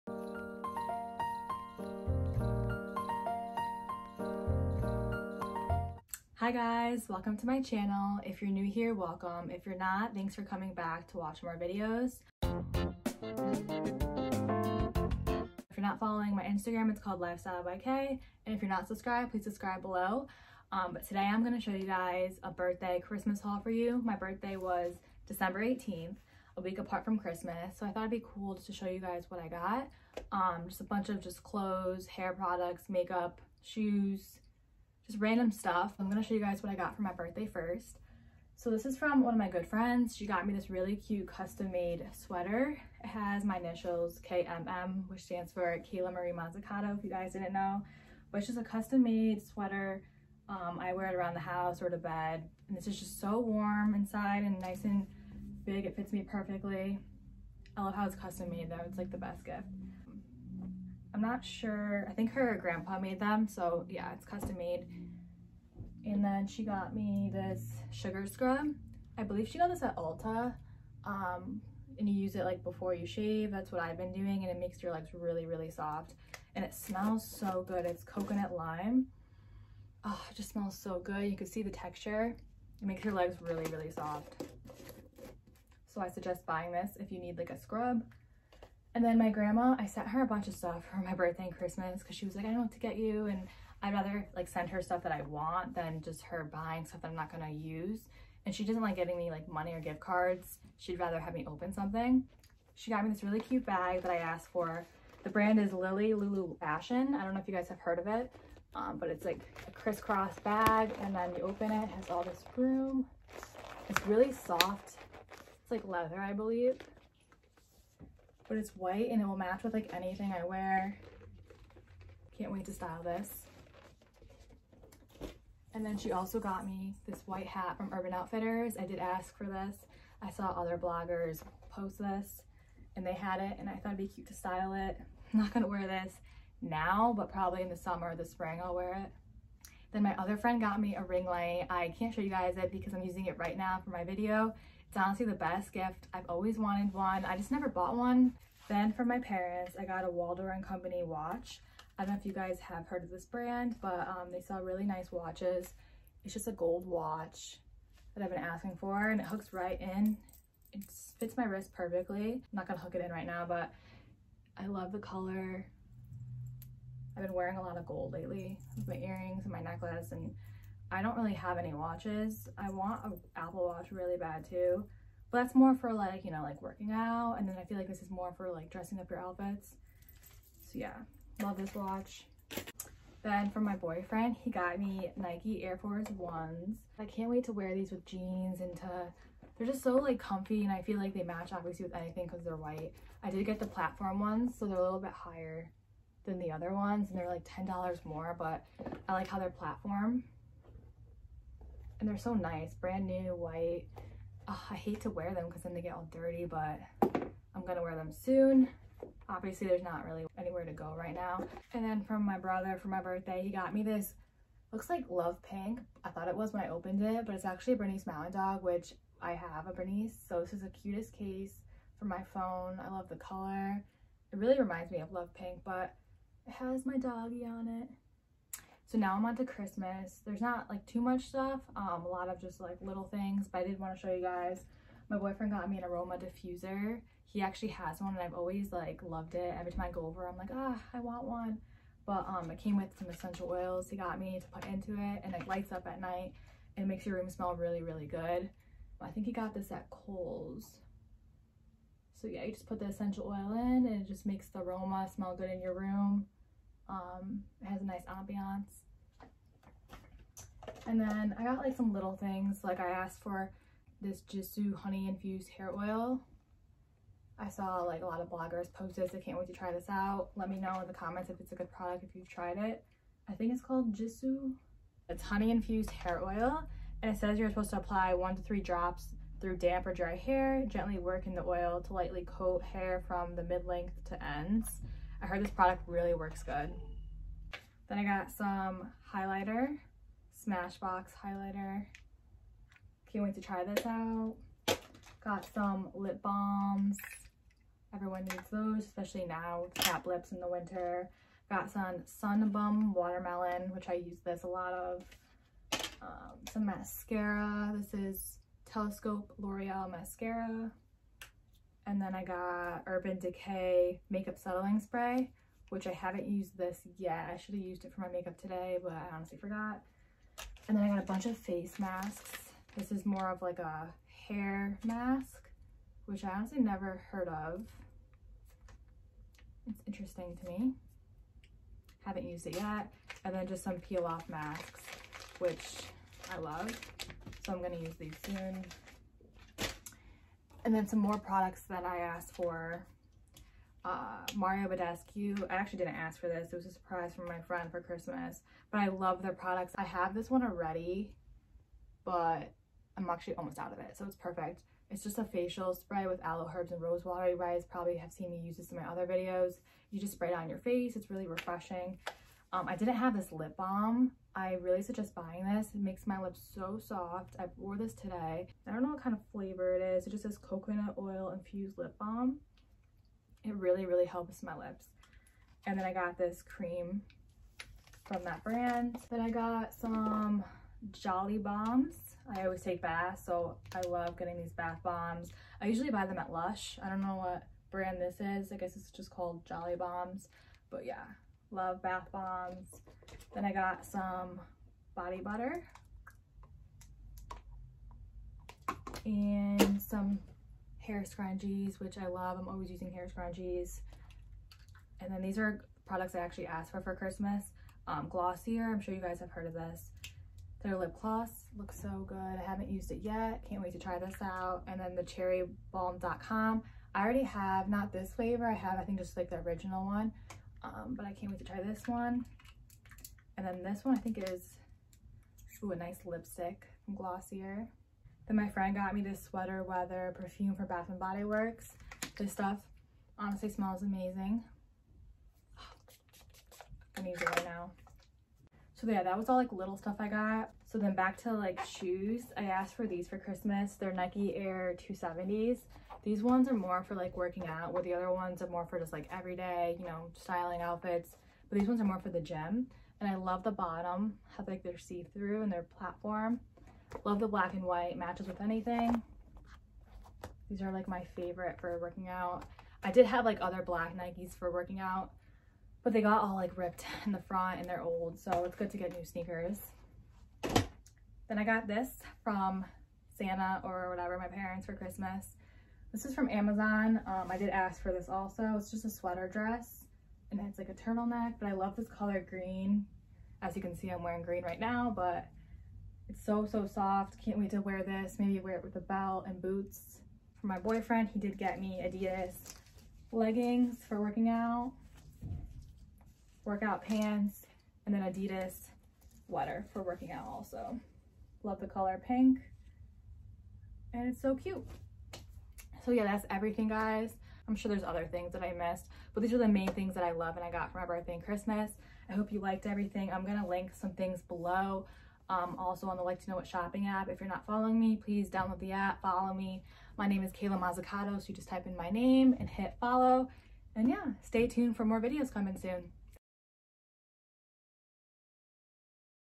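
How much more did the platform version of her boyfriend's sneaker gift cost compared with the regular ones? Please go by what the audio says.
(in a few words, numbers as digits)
$10.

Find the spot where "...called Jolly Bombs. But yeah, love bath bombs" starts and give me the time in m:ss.
6:29.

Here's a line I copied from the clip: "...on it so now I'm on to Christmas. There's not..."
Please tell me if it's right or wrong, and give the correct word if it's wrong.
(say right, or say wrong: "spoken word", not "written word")
right.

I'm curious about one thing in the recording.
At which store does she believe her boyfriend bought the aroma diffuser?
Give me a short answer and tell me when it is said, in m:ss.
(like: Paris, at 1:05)
Kohl's, at 4:09.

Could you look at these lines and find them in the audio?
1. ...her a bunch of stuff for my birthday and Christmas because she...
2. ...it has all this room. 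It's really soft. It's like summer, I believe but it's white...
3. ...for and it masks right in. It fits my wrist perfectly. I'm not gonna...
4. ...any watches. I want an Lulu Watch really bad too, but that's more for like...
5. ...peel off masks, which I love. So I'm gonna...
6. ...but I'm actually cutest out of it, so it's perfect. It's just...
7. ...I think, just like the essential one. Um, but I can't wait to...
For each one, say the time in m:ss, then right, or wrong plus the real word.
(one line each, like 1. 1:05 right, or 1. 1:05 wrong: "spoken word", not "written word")
1. 1:30 right
2. 1:51 wrong: "leather", not "summer"
3. 2:38 wrong: "hooks", not "masks"
4. 2:51 wrong: "Apple", not "Lulu"
5. 5:33 right
6. 5:52 wrong: "almost", not "cutest"
7. 6:58 wrong: "original", not "essential".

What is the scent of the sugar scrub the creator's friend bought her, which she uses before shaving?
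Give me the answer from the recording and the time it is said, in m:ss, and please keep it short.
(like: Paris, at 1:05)
Coconut lime, at 1:18.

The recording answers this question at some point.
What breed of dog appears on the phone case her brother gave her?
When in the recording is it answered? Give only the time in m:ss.
3:37.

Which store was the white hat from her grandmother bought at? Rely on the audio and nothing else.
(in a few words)
Urban Outfitters.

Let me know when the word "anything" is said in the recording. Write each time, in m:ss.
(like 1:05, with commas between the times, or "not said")
1:59, 3:11, 7:38.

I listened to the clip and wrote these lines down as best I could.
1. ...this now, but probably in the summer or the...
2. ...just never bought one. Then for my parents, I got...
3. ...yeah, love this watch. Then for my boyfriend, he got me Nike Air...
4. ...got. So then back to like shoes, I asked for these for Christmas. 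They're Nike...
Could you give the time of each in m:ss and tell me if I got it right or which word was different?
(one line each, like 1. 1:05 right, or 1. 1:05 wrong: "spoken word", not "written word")
1. 2:15 right
2. 2:27 right
3. 3:00 right
4. 7:20 right.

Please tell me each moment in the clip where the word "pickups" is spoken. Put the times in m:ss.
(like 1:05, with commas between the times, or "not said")
not said.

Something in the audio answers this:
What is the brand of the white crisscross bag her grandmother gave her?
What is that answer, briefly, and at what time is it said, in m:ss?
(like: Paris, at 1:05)
Lily Lulu Fashion, at 1:45.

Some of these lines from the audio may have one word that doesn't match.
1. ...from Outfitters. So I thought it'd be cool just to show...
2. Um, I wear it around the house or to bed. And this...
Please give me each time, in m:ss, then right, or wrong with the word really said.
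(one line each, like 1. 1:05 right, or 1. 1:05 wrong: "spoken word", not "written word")
1. 0:27 wrong: "Christmas", not "Outfitters"
2. 0:50 right.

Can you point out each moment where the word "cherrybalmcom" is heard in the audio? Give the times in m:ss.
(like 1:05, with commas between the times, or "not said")
6:55.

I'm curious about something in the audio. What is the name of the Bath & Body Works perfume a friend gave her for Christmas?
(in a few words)
Sweater Weather.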